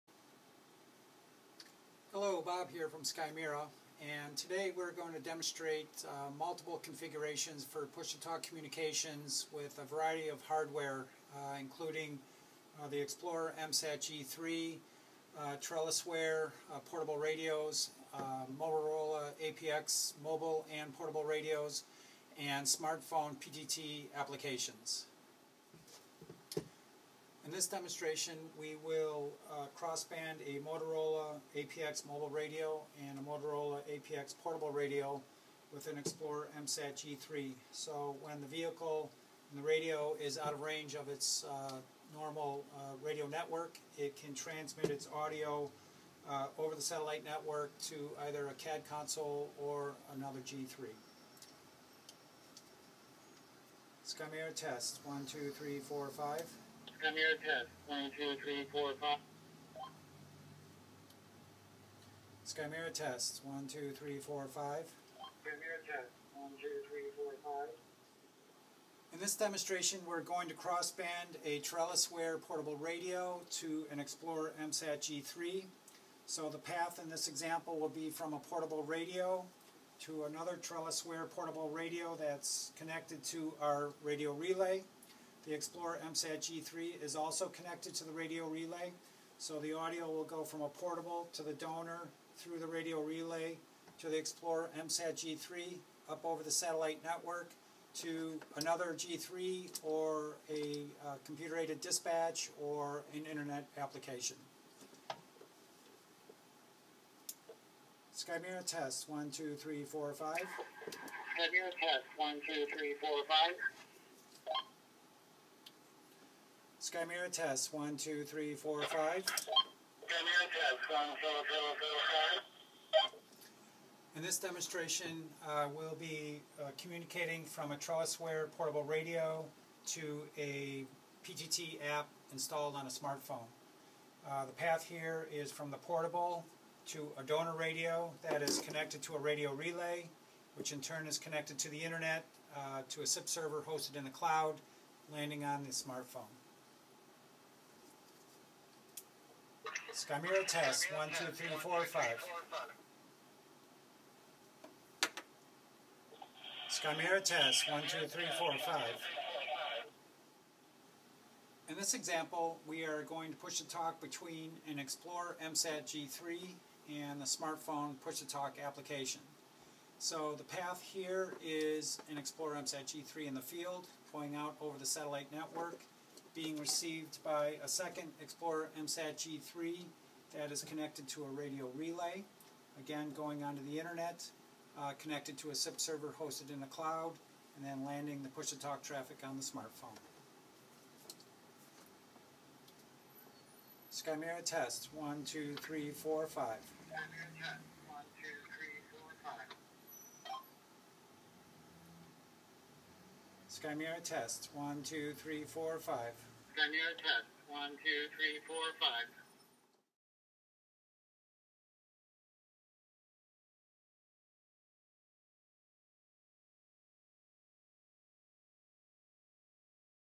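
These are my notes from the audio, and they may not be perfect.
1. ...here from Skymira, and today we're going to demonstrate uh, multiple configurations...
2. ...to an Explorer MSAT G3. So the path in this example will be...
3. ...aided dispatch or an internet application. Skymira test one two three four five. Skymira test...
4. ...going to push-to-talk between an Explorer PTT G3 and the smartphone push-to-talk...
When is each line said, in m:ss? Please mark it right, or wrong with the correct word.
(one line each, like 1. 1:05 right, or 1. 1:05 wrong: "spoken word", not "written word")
1. 0:02 right
2. 1:13 right
3. 1:41 right
4. 2:43 wrong: "MSAT", not "PTT".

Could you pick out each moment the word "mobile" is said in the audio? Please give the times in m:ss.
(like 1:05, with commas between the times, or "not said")
0:20, 0:32.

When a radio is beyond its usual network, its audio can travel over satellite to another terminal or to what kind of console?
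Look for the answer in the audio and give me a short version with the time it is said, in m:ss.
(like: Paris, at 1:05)
CAD console, at 0:48.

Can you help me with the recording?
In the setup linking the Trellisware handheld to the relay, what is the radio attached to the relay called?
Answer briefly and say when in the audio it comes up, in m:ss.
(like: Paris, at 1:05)
donor radio, at 2:17.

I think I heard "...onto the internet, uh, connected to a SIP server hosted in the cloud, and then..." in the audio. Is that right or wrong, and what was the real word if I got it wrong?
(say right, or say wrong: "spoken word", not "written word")
right.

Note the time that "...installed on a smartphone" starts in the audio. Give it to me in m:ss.
2:12.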